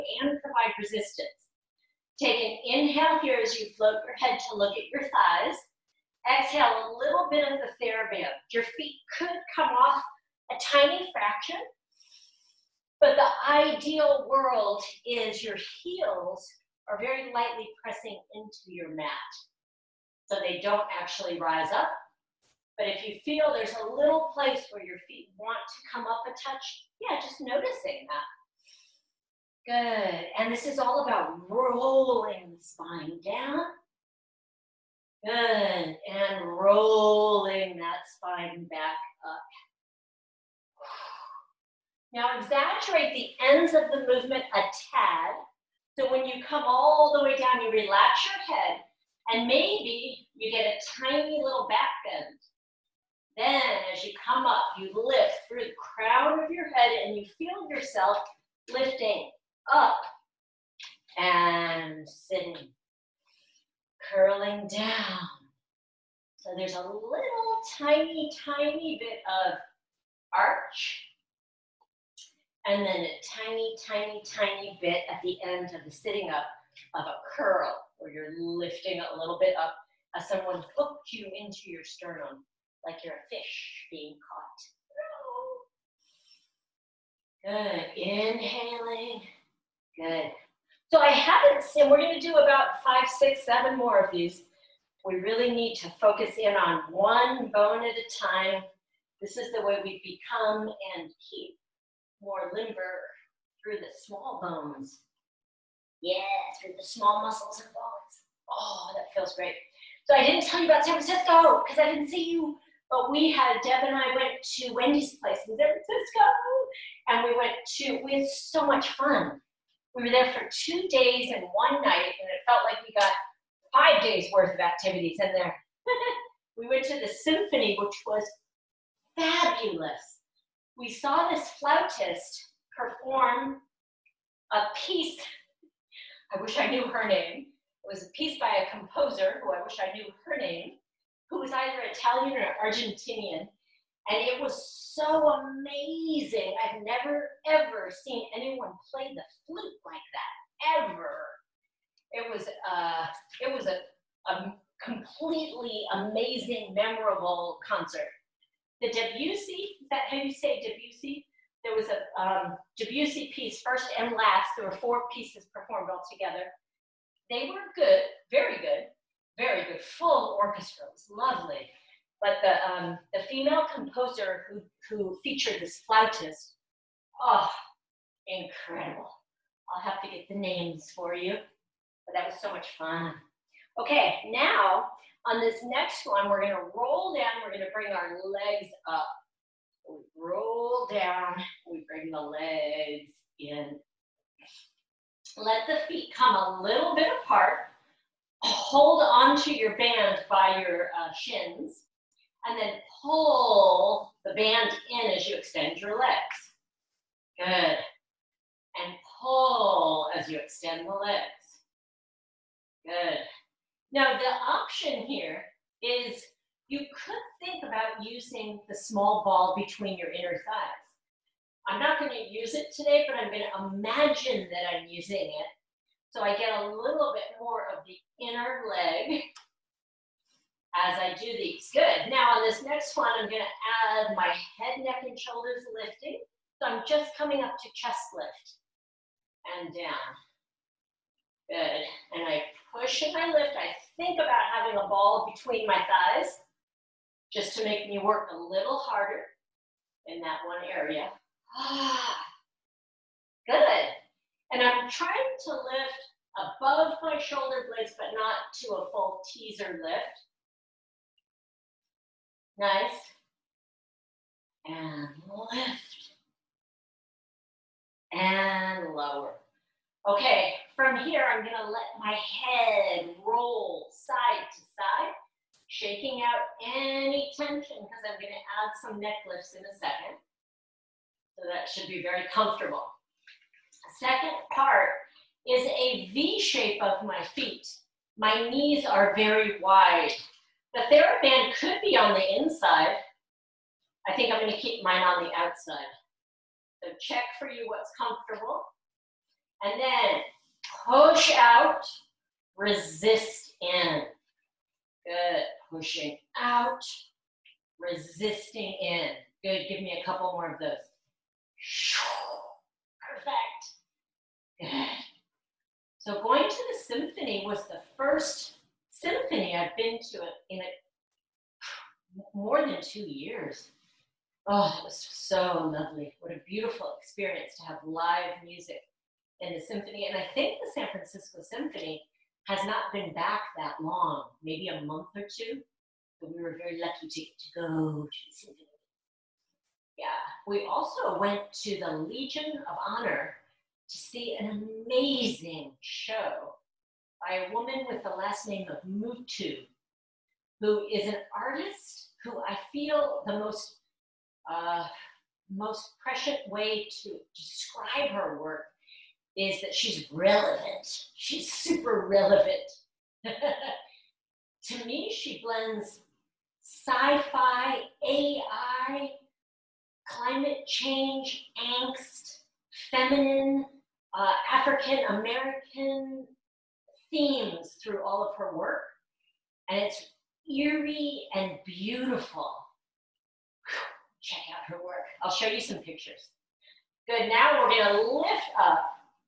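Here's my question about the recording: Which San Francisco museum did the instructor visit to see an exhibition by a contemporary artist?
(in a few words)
Legion of Honor.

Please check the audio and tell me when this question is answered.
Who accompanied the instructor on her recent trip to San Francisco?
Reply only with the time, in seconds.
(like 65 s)
113 s.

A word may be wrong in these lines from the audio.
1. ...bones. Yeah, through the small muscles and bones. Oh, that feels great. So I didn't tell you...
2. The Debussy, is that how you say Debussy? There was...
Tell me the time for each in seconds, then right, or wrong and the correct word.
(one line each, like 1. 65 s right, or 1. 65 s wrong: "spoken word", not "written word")
1. 104 s right
2. 158 s right.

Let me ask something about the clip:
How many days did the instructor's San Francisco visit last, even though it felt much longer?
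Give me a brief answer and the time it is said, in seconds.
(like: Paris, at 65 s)
2 days, at 120 s.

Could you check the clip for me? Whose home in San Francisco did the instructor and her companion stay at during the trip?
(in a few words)
Wendy's.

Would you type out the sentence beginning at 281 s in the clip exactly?
So that should be very comfortable.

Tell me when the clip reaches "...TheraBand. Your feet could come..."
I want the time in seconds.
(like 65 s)
7 s.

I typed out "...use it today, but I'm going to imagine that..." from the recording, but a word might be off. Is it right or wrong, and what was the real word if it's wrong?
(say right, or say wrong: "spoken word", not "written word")
right.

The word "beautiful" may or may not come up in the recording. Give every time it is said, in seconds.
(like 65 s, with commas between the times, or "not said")
326 s, 381 s.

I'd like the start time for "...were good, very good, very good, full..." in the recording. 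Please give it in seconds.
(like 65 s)
167 s.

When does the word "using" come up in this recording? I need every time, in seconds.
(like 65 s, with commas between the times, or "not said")
218 s, 224 s.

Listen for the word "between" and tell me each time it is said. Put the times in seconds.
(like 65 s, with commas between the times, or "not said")
219 s, 245 s.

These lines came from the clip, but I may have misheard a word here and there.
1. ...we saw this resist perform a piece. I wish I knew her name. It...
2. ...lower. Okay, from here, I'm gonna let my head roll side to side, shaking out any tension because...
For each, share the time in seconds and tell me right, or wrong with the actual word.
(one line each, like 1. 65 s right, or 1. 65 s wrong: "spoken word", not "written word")
1. 130 s wrong: "flautist", not "resist"
2. 268 s right.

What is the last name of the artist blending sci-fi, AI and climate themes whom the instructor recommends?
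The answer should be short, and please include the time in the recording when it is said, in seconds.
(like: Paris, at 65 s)
Mutu, at 348 s.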